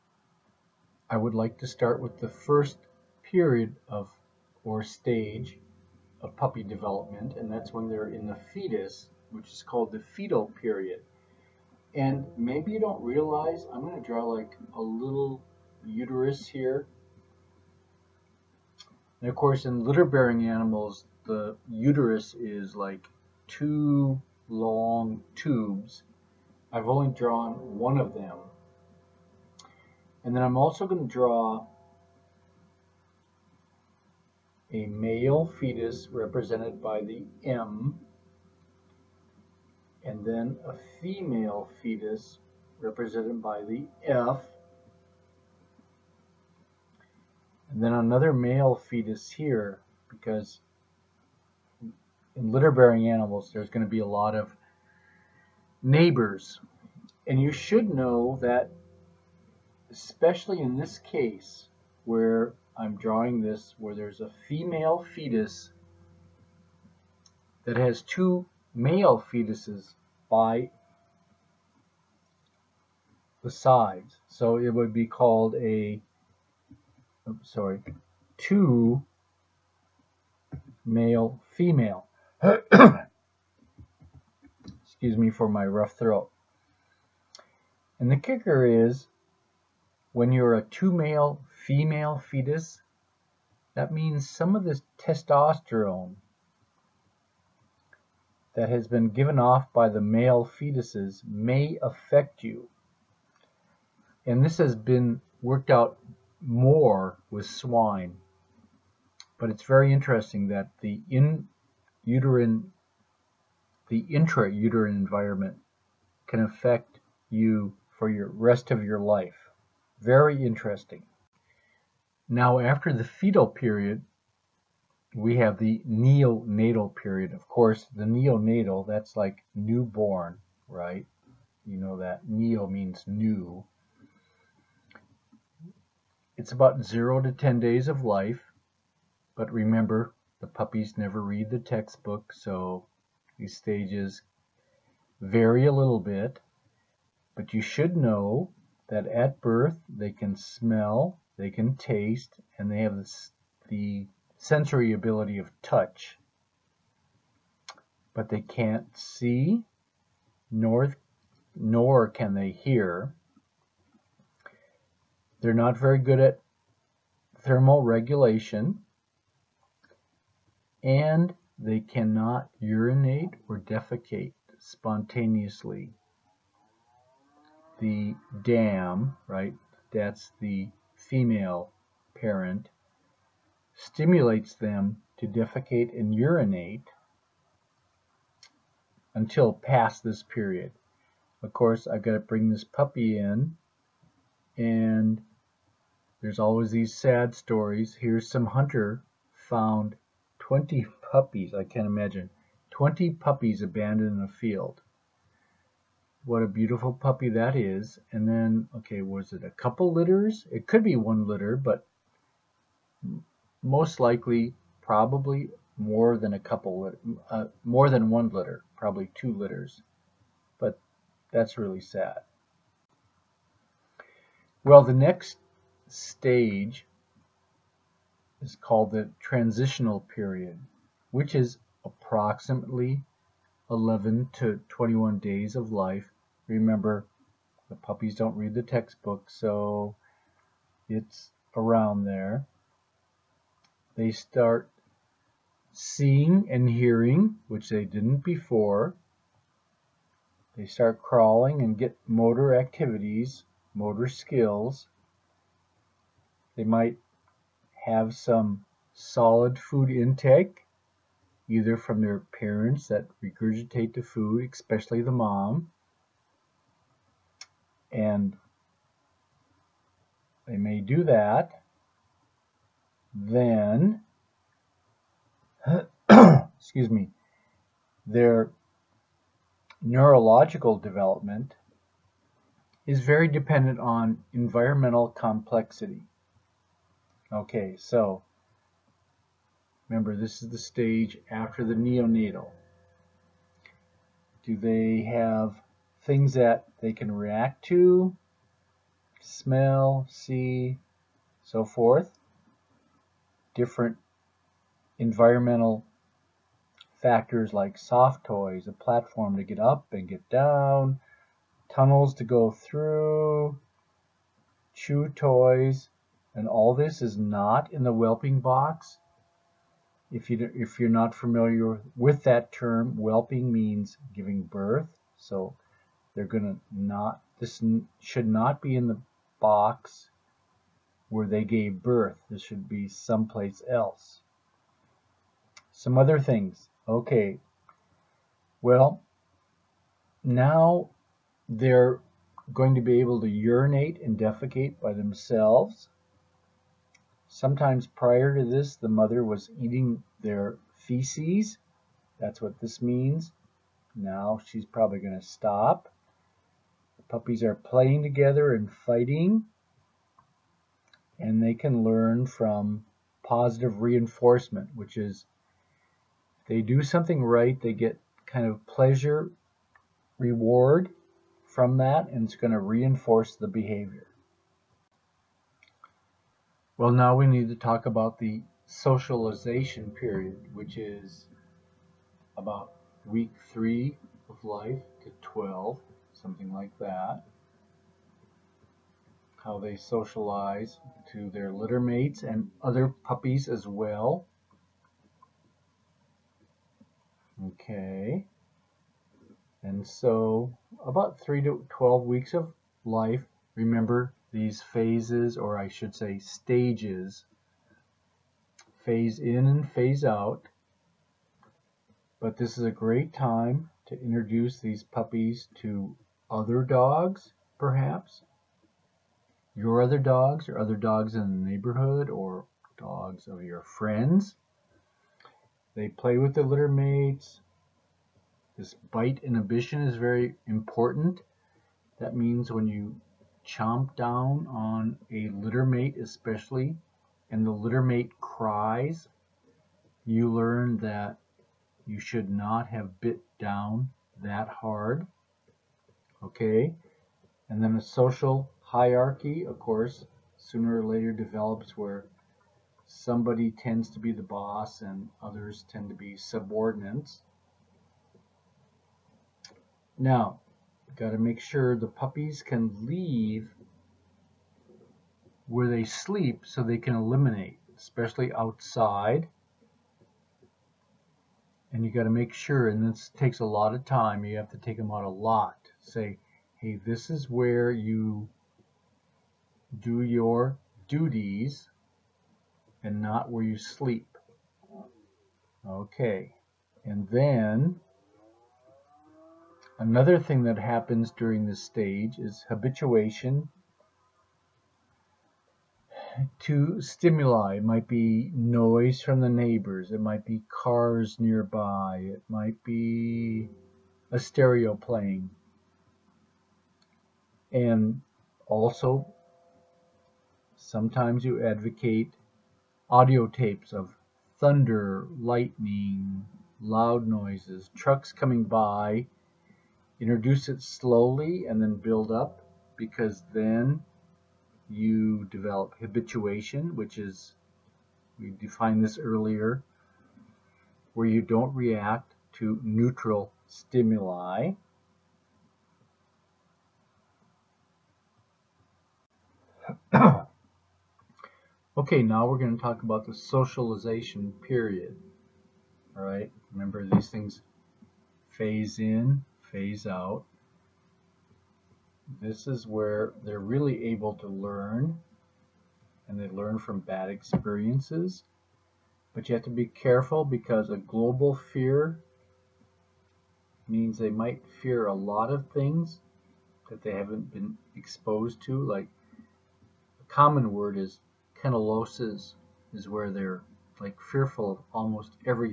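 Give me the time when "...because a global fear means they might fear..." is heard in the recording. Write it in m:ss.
9:20.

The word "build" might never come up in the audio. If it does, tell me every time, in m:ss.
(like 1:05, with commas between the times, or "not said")
8:41.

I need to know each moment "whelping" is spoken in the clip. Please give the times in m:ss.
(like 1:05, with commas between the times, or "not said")
5:17, 5:22.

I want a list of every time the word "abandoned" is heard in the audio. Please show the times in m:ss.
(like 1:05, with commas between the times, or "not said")
3:23.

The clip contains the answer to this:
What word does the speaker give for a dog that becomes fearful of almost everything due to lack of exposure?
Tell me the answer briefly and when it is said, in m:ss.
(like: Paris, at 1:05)
kennelosis, at 9:31.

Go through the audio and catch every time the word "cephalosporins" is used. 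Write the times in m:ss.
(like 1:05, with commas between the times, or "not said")
not said.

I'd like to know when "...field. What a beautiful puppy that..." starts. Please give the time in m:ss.
3:24.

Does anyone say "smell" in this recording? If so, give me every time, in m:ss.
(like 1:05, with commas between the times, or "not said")
2:30, 4:59.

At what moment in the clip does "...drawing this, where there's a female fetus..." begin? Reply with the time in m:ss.
1:02.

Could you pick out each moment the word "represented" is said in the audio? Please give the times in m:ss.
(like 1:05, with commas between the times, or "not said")
0:36, 0:42.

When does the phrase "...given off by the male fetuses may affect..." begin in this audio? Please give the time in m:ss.
1:39.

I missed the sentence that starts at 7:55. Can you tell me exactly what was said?
Say, hey, this is where you do your duties and not where you sleep.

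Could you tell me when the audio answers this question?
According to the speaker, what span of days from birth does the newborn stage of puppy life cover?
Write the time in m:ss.
2:16.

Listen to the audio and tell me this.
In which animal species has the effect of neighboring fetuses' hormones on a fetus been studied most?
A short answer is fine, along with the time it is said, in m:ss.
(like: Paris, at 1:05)
swine, at 1:47.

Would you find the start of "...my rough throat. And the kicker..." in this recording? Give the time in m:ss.
1:25.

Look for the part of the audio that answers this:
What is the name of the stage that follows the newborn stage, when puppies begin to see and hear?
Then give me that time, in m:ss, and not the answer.
3:49.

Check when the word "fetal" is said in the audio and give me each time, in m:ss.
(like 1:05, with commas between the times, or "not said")
0:10, 2:03.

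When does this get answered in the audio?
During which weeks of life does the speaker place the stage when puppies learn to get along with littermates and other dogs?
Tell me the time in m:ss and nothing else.
6:41.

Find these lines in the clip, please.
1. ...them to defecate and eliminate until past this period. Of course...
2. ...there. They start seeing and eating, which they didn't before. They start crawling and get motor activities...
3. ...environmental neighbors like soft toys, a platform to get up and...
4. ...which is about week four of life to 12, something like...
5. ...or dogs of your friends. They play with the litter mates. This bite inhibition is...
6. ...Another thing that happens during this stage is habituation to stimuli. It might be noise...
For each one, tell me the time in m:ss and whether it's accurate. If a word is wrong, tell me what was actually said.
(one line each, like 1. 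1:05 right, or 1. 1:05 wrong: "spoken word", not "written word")
1. 3:04 wrong: "urinate", not "eliminate"
2. 4:02 wrong: "hearing", not "eating"
3. 5:04 wrong: "factors", not "neighbors"
4. 6:20 wrong: "three", not "four"
5. 7:02 right
6. 8:09 right.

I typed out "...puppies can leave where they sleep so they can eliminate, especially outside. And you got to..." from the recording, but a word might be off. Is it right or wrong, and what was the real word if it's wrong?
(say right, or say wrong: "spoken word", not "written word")
right.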